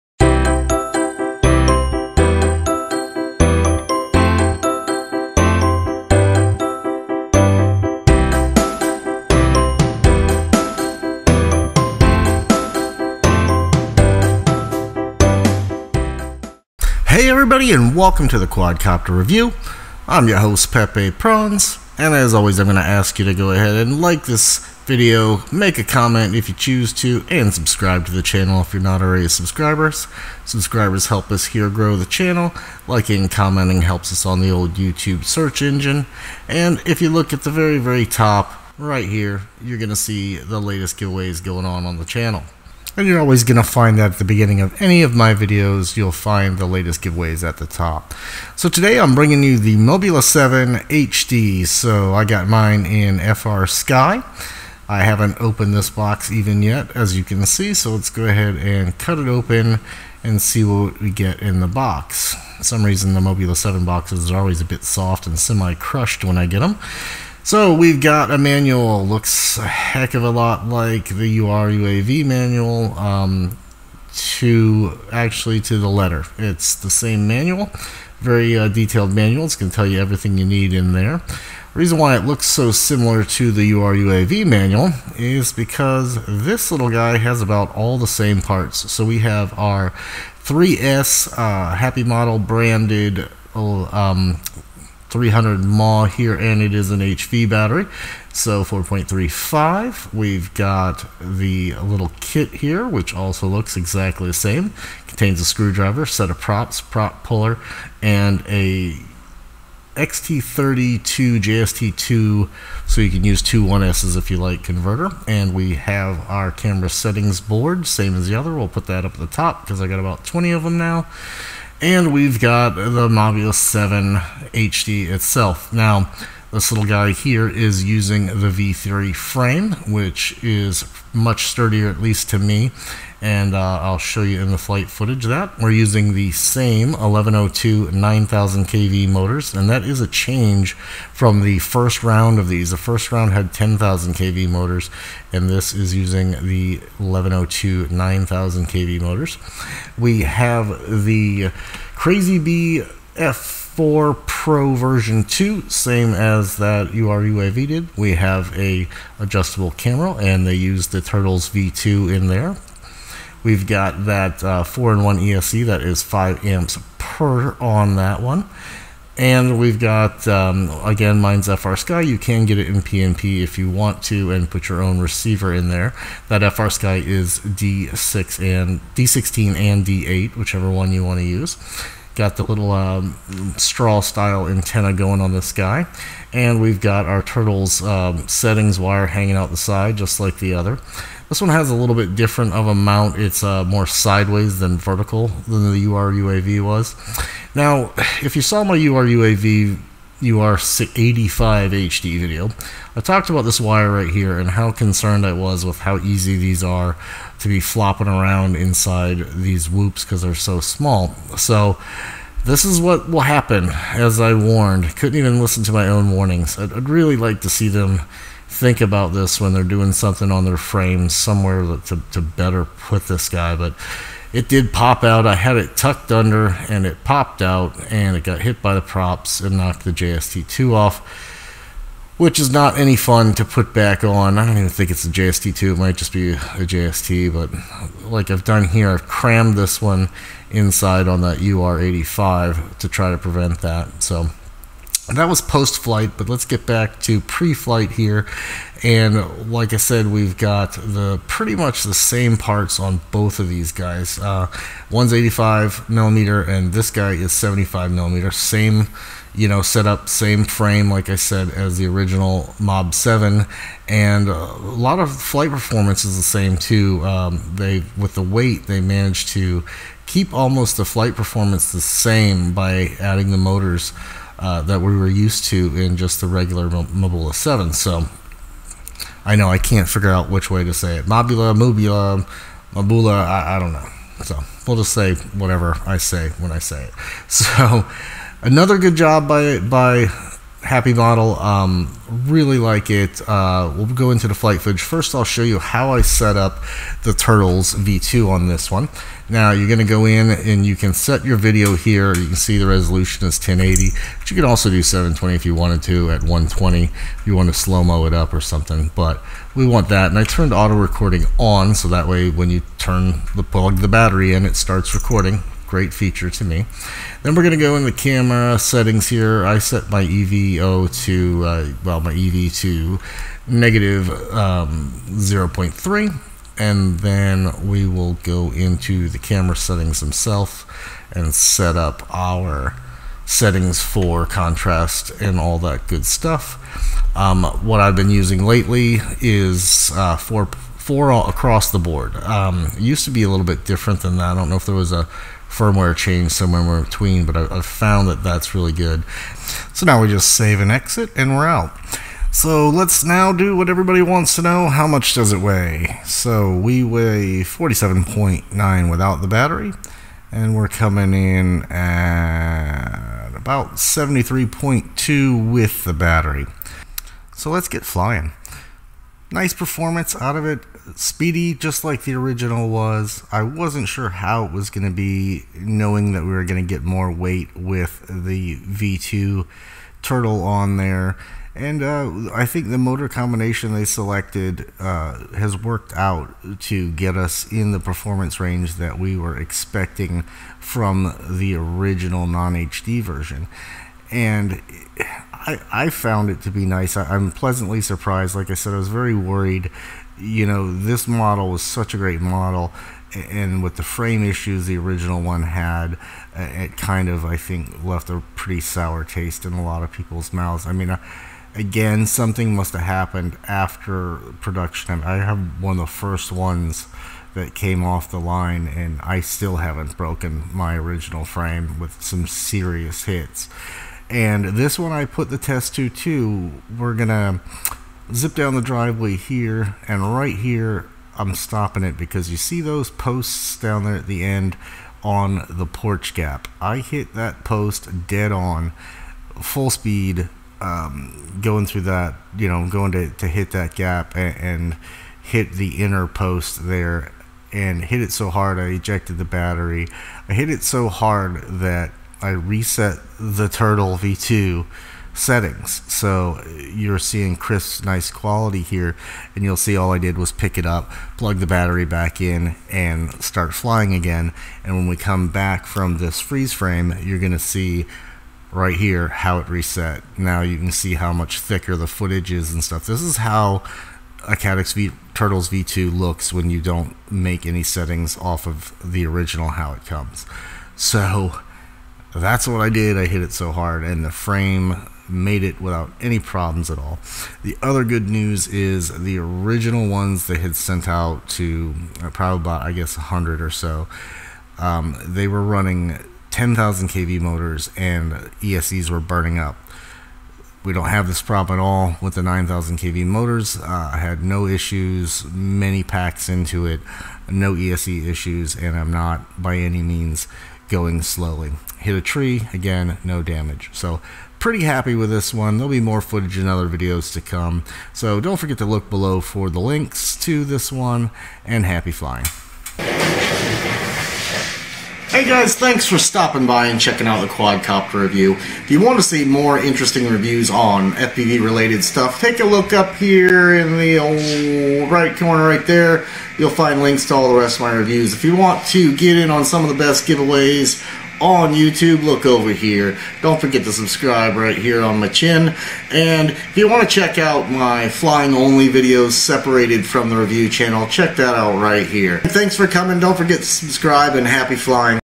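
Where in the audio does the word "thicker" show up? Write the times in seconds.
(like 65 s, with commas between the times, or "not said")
471 s.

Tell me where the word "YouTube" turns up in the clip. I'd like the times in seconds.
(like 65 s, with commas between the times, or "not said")
34 s, 541 s.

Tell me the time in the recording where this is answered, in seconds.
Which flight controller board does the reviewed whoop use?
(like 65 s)
151 s.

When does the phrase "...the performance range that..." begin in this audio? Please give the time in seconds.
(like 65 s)
387 s.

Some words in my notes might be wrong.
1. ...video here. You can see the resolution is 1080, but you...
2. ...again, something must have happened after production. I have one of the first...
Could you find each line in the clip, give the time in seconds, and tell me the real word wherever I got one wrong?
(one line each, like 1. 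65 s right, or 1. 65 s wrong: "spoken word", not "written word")
1. 301 s right
2. 411 s right.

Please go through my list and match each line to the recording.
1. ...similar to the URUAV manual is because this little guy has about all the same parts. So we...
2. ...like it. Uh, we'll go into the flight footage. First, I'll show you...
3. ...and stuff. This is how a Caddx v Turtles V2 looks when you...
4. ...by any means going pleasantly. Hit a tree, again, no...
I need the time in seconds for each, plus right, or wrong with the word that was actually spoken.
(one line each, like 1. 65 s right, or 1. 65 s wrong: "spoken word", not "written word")
1. 82 s right
2. 292 s right
3. 472 s right
4. 509 s wrong: "slowly", not "pleasantly".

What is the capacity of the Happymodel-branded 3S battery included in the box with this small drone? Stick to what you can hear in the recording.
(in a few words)
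300 mAh.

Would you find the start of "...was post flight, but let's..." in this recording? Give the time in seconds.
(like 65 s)
245 s.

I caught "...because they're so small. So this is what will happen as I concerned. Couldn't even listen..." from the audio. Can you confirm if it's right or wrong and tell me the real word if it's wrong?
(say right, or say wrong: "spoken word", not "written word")
wrong: "warned", not "concerned".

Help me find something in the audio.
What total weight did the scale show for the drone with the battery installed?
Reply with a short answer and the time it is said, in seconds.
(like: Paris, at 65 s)
73.2, at 363 s.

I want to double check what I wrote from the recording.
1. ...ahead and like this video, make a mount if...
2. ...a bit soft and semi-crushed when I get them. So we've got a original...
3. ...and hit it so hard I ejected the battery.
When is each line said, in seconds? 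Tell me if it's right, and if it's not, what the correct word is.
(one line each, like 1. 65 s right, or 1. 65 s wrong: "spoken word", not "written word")
1. 23 s wrong: "comment", not "mount"
2. 64 s wrong: "manual", not "original"
3. 447 s right.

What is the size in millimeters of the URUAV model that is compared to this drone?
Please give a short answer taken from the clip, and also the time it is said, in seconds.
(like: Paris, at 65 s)
85 millimeter, at 255 s.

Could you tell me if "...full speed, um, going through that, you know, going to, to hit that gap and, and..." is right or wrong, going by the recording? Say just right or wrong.
right.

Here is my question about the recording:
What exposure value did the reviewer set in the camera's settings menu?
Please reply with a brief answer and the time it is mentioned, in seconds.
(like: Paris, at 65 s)
-0.3, at 323 s.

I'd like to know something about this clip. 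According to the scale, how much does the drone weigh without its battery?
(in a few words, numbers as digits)
47.9.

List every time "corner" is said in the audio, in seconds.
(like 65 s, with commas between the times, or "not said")
535 s.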